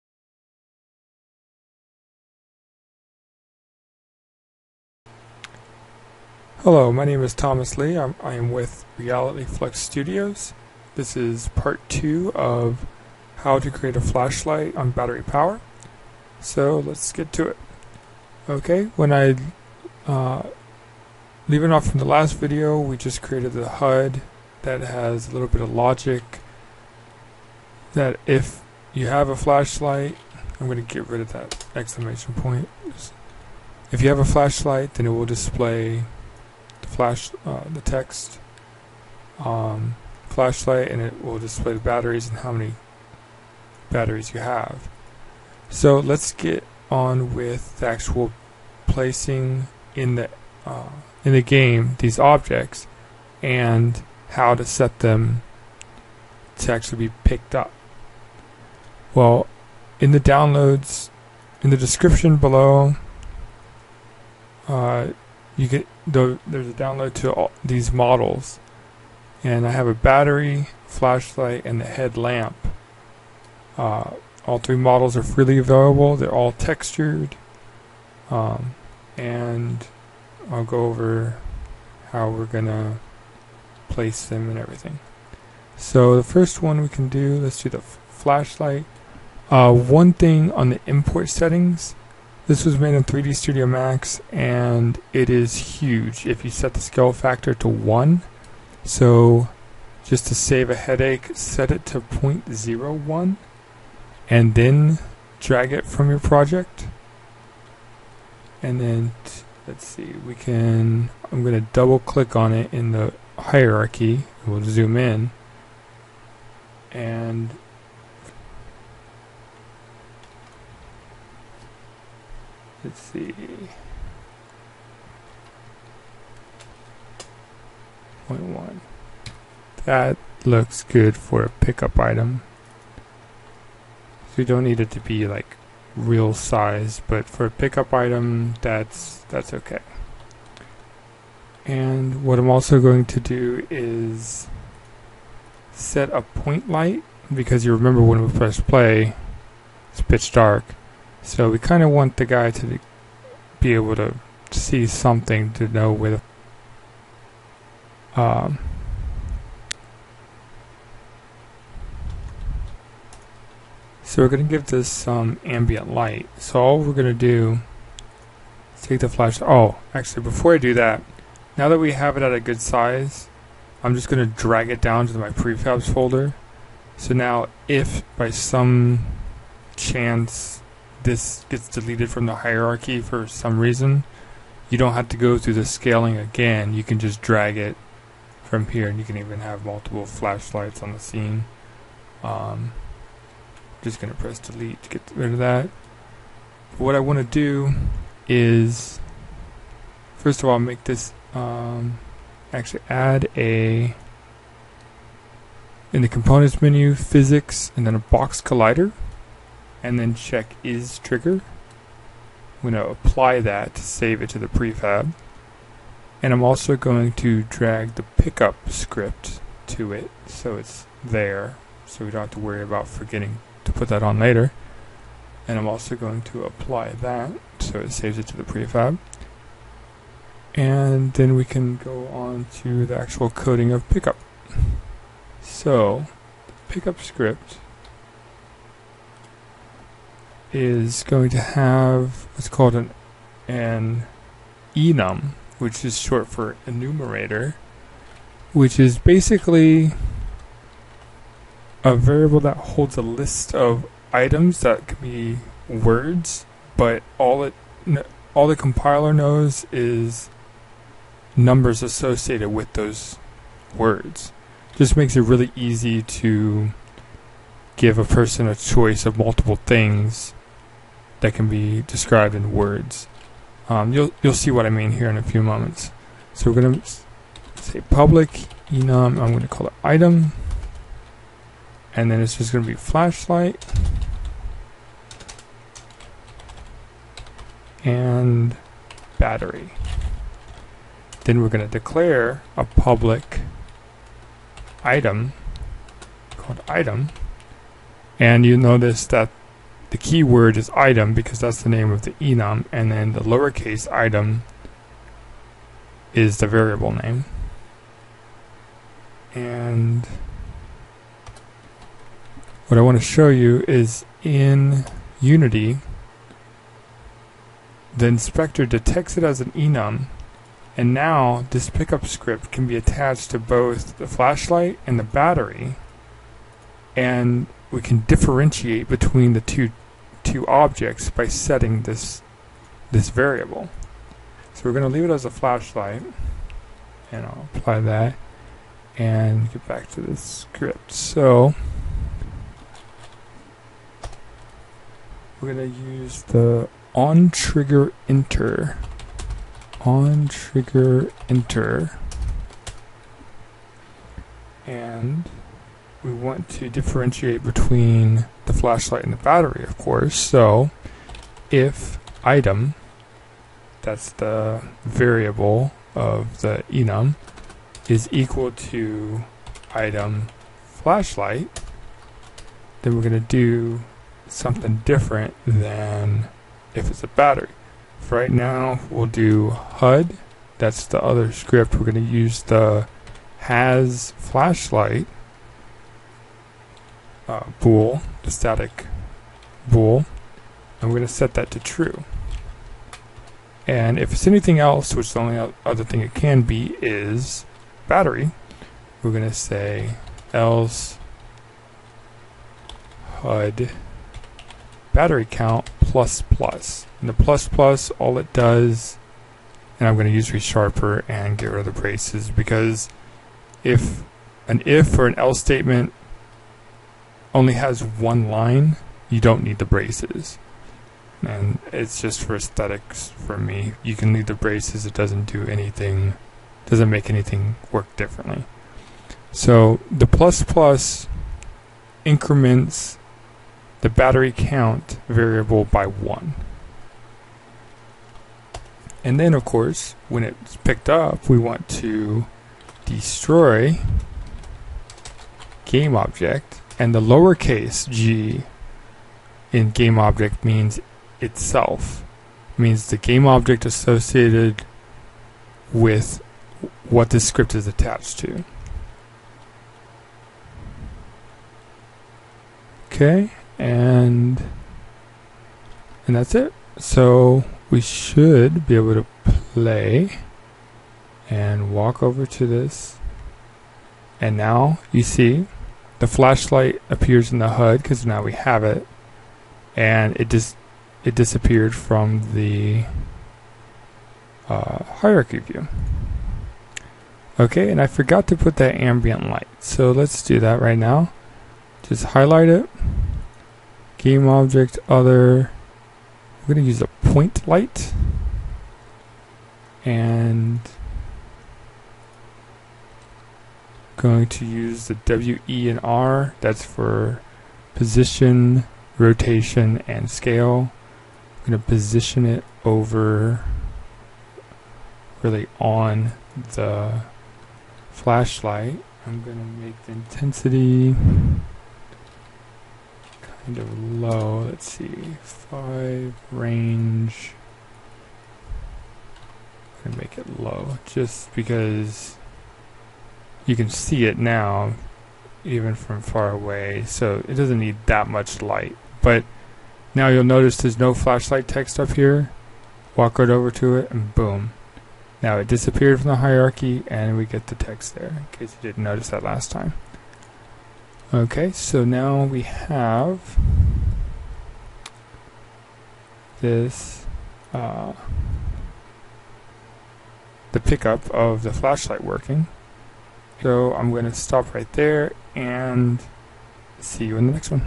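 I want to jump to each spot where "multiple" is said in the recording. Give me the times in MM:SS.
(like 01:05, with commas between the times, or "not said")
03:09, 04:29.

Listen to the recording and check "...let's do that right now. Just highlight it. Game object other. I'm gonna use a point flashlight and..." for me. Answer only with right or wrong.
wrong.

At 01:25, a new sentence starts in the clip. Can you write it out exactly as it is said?
So the first one we can do, let's do the flashlight.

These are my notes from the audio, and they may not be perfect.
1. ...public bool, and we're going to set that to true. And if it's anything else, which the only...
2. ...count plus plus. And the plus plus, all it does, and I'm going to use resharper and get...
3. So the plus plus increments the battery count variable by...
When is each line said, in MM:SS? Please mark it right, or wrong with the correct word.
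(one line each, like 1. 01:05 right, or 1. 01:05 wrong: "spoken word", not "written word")
1. 06:28 wrong: "static", not "public"
2. 06:45 right
3. 07:09 right.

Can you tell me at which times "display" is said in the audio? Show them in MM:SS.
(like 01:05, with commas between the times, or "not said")
00:35, 00:41.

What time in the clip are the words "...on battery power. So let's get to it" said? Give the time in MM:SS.
00:14.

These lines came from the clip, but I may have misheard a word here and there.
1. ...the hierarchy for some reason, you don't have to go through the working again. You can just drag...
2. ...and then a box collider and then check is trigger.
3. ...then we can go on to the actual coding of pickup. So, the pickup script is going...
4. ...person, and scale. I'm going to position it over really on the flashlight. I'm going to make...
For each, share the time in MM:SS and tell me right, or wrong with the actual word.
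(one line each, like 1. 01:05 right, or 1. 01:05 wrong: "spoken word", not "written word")
1. 03:02 wrong: "scaling", not "working"
2. 03:27 right
3. 03:51 right
4. 08:28 wrong: "rotation", not "person".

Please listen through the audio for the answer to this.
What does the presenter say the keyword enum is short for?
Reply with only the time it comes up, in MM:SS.
04:06.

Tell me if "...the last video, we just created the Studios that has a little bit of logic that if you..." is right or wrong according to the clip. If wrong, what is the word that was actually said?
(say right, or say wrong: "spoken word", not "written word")
wrong: "HUD", not "Studios".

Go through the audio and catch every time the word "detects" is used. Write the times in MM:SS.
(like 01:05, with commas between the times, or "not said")
05:18.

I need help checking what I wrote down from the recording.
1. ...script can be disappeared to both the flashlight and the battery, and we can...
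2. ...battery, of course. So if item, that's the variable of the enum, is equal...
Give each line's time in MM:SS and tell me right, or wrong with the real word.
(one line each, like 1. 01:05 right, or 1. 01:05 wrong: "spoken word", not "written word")
1. 05:22 wrong: "attached", not "disappeared"
2. 05:59 right.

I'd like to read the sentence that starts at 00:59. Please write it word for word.
Well, in the downloads, in the description below, uh, you get there's a download to all these models.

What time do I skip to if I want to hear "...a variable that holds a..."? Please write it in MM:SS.
04:11.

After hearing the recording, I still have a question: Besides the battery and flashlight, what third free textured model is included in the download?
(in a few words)
headlamp.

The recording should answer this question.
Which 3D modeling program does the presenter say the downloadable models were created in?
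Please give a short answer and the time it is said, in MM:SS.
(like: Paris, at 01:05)
3D Studio Max, at 01:33.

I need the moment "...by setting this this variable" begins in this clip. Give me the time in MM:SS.
05:31.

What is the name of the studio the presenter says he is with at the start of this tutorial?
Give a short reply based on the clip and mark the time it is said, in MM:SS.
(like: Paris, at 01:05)
Reality Flux Studios, at 00:08.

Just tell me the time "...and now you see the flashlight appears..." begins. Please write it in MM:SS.
07:54.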